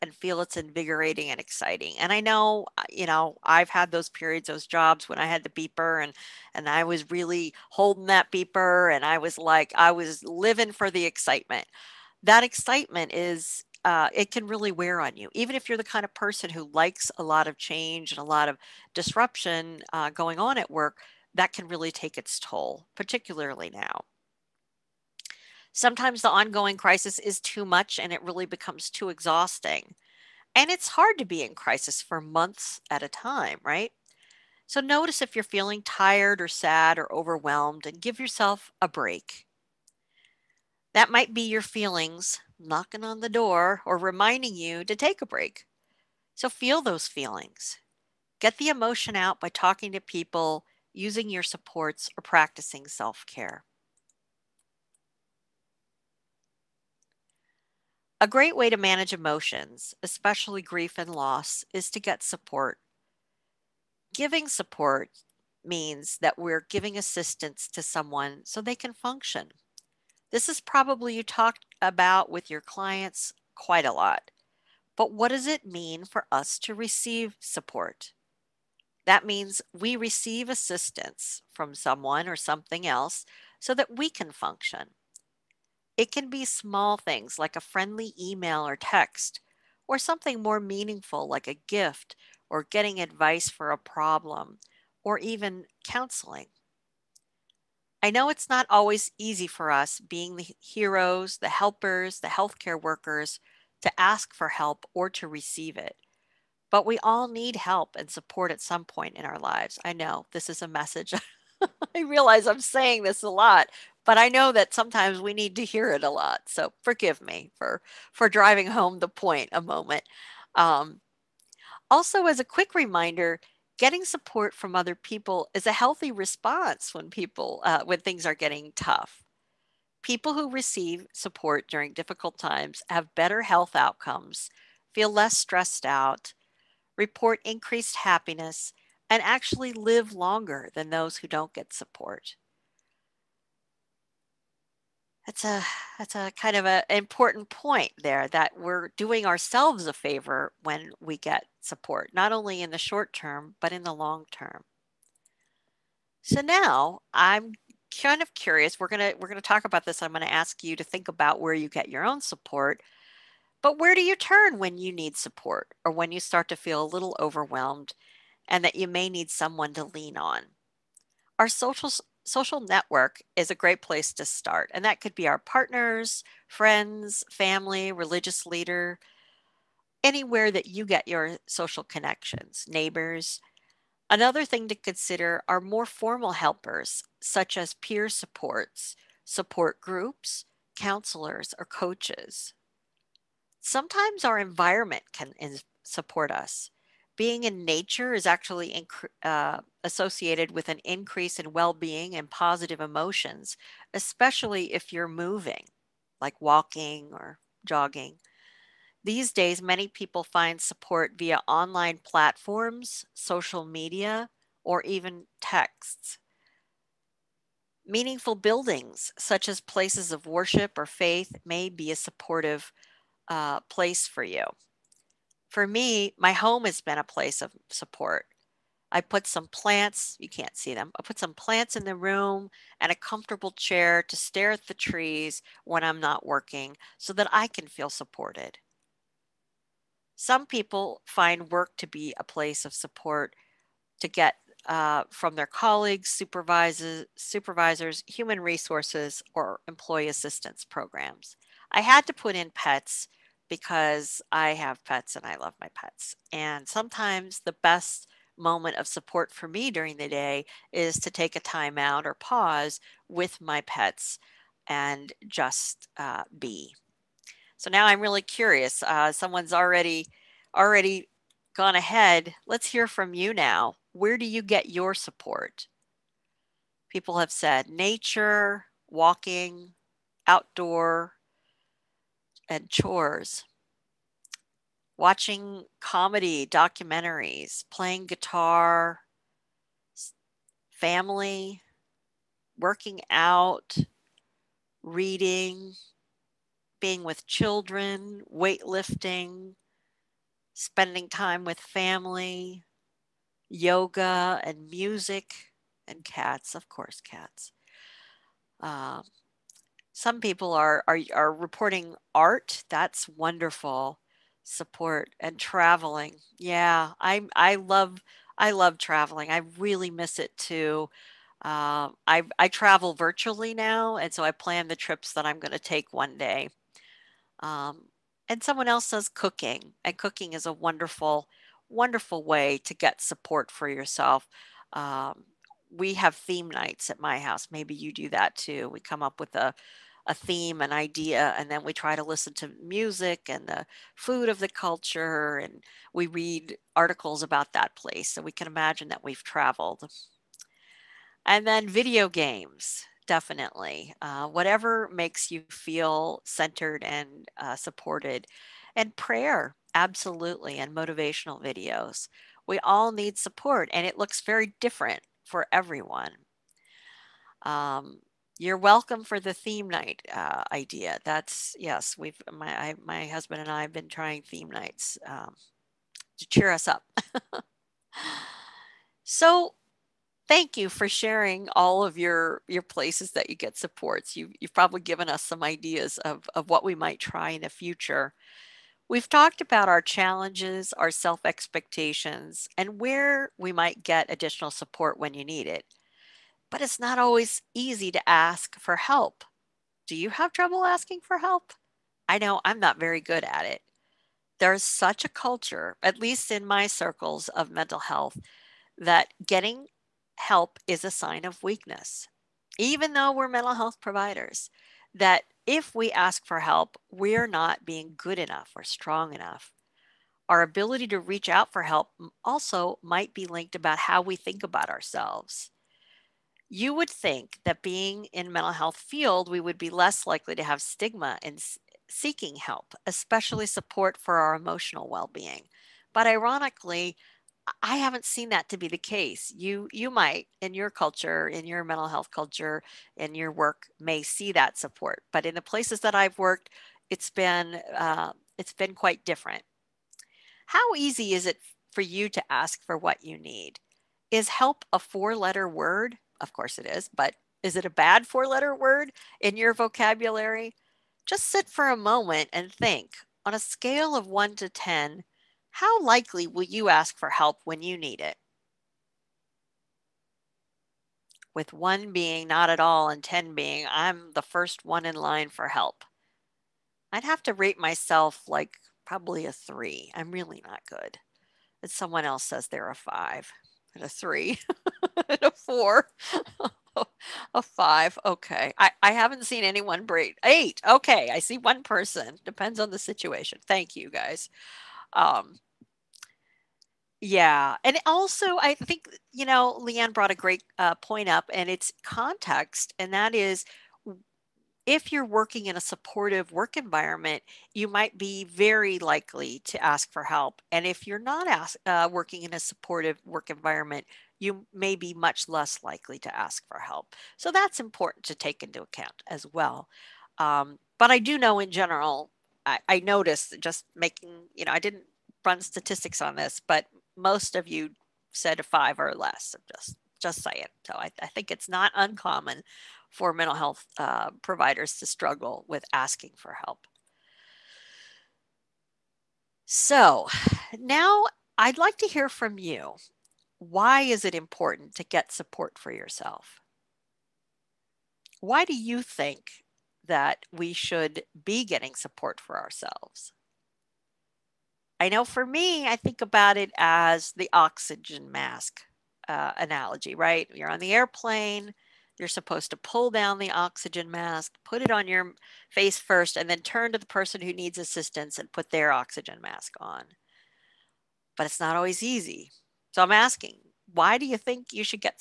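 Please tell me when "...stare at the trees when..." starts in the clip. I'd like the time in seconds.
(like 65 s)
234 s.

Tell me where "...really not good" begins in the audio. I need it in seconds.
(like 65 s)
480 s.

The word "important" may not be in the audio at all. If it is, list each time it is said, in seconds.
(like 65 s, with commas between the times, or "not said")
146 s, 517 s, 544 s.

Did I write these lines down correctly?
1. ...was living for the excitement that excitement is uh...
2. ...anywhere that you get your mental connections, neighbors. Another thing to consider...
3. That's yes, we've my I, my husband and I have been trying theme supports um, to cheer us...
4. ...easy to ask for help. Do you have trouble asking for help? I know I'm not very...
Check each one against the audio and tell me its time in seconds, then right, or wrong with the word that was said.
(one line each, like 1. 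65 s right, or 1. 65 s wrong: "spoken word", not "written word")
1. 9 s right
2. 180 s wrong: "social", not "mental"
3. 371 s wrong: "nights", not "supports"
4. 397 s right.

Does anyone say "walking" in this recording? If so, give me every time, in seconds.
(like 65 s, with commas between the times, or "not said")
206 s, 278 s.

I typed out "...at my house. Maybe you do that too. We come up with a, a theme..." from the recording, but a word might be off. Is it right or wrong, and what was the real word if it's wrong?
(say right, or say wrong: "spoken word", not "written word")
right.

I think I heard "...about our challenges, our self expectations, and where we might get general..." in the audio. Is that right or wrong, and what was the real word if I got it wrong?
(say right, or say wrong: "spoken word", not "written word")
wrong: "additional", not "general".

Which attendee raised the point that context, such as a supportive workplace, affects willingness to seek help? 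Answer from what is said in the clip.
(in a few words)
Leanne.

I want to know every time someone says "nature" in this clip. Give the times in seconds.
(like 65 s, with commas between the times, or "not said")
197 s, 277 s.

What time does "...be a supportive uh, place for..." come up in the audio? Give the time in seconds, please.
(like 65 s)
221 s.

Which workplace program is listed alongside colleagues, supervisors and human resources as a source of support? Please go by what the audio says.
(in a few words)
employee assistance programs.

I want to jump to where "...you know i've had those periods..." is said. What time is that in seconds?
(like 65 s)
2 s.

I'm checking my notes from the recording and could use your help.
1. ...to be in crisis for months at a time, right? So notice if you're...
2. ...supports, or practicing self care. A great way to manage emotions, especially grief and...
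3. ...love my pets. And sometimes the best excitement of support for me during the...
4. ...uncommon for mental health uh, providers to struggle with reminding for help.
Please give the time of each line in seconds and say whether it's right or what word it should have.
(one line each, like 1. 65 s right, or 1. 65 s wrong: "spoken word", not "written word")
1. 31 s right
2. 51 s right
3. 255 s wrong: "moment", not "excitement"
4. 531 s wrong: "asking", not "reminding".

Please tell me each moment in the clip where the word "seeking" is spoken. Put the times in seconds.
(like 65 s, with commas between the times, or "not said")
431 s.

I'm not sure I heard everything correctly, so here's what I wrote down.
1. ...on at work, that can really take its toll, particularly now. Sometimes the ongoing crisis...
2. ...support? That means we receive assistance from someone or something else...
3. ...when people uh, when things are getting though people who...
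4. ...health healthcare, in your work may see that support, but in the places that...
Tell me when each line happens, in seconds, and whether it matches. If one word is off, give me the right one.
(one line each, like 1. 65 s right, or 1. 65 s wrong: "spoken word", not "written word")
1. 20 s right
2. 77 s right
3. 126 s wrong: "tough", not "though"
4. 441 s wrong: "culture", not "healthcare".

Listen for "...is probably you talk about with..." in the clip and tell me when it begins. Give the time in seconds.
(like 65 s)
70 s.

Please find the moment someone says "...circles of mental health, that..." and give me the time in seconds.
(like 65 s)
406 s.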